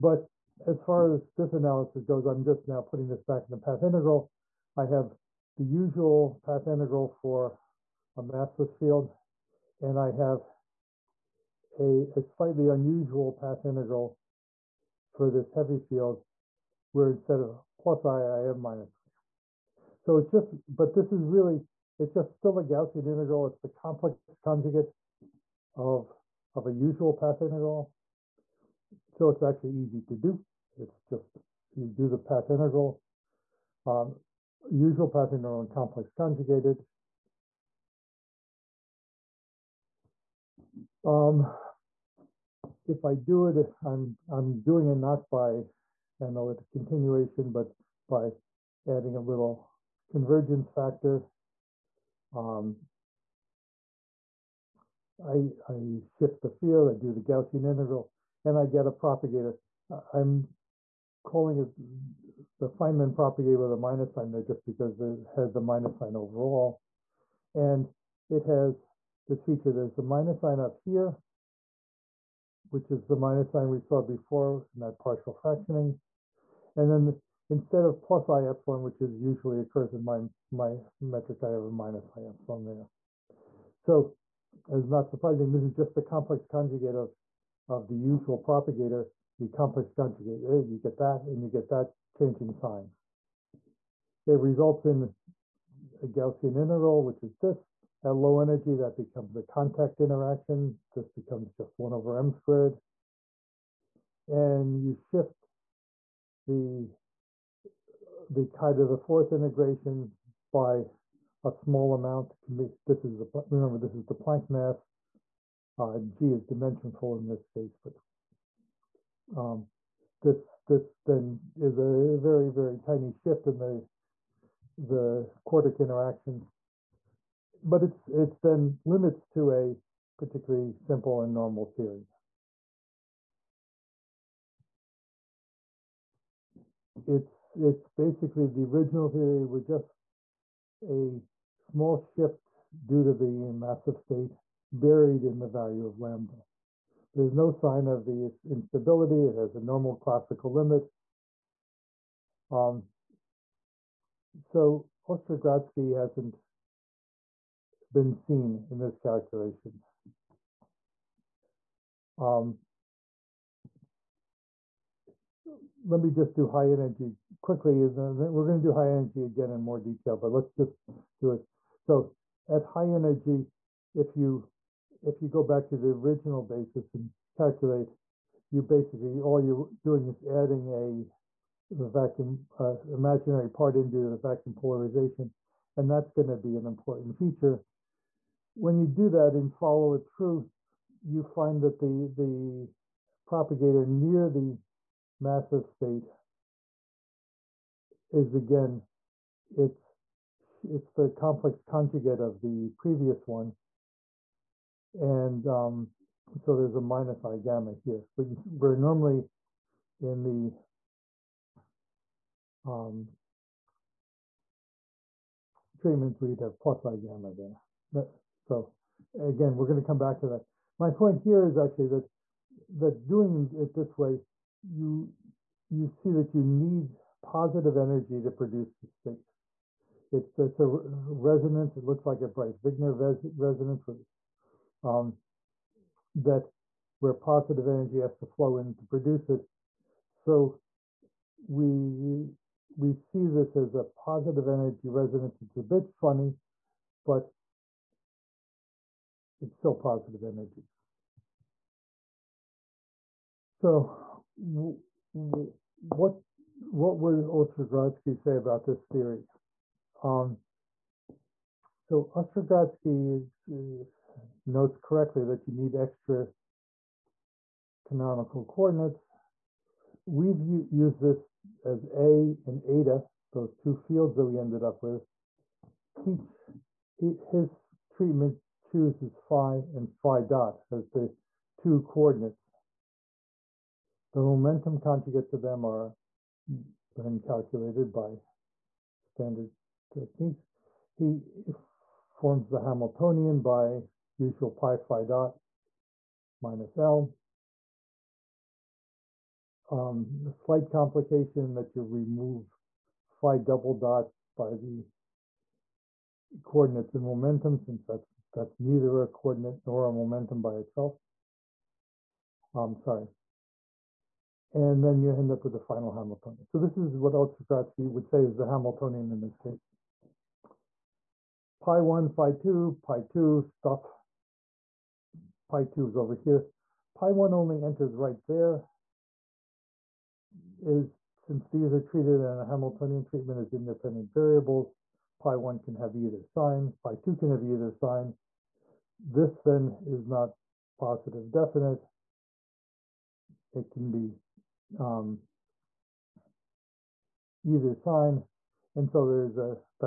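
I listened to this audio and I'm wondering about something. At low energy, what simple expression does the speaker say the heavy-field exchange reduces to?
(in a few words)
1 over m squared.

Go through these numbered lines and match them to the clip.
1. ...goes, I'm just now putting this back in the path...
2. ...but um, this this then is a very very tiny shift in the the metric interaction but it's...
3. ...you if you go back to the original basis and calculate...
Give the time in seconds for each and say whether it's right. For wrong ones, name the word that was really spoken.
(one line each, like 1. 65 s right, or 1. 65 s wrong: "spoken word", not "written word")
1. 2 s right
2. 117 s wrong: "quartic", not "metric"
3. 174 s right.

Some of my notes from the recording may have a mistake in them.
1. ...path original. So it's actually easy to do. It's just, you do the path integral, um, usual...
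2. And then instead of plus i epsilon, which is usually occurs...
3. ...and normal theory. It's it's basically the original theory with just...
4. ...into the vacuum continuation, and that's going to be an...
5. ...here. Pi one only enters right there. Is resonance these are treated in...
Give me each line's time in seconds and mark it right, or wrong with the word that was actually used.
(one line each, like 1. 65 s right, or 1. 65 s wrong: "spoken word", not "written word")
1. 27 s wrong: "integral", not "original"
2. 76 s right
3. 131 s right
4. 183 s wrong: "polarization", not "continuation"
5. 326 s wrong: "since", not "resonance".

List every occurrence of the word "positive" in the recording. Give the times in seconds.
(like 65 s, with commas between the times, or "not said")
227 s, 237 s, 244 s, 249 s, 340 s.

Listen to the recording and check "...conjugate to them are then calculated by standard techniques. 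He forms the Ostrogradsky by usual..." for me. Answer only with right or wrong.
wrong.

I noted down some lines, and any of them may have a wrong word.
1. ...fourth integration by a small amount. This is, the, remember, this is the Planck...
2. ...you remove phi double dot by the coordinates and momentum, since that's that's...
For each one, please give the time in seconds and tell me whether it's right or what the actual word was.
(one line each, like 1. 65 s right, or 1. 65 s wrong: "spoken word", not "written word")
1. 108 s right
2. 301 s right.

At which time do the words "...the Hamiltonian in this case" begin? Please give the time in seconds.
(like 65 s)
318 s.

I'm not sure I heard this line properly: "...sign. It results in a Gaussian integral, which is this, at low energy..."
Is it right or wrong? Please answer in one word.
right.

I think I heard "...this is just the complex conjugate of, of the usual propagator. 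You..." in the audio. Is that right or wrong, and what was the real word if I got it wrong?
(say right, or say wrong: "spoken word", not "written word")
right.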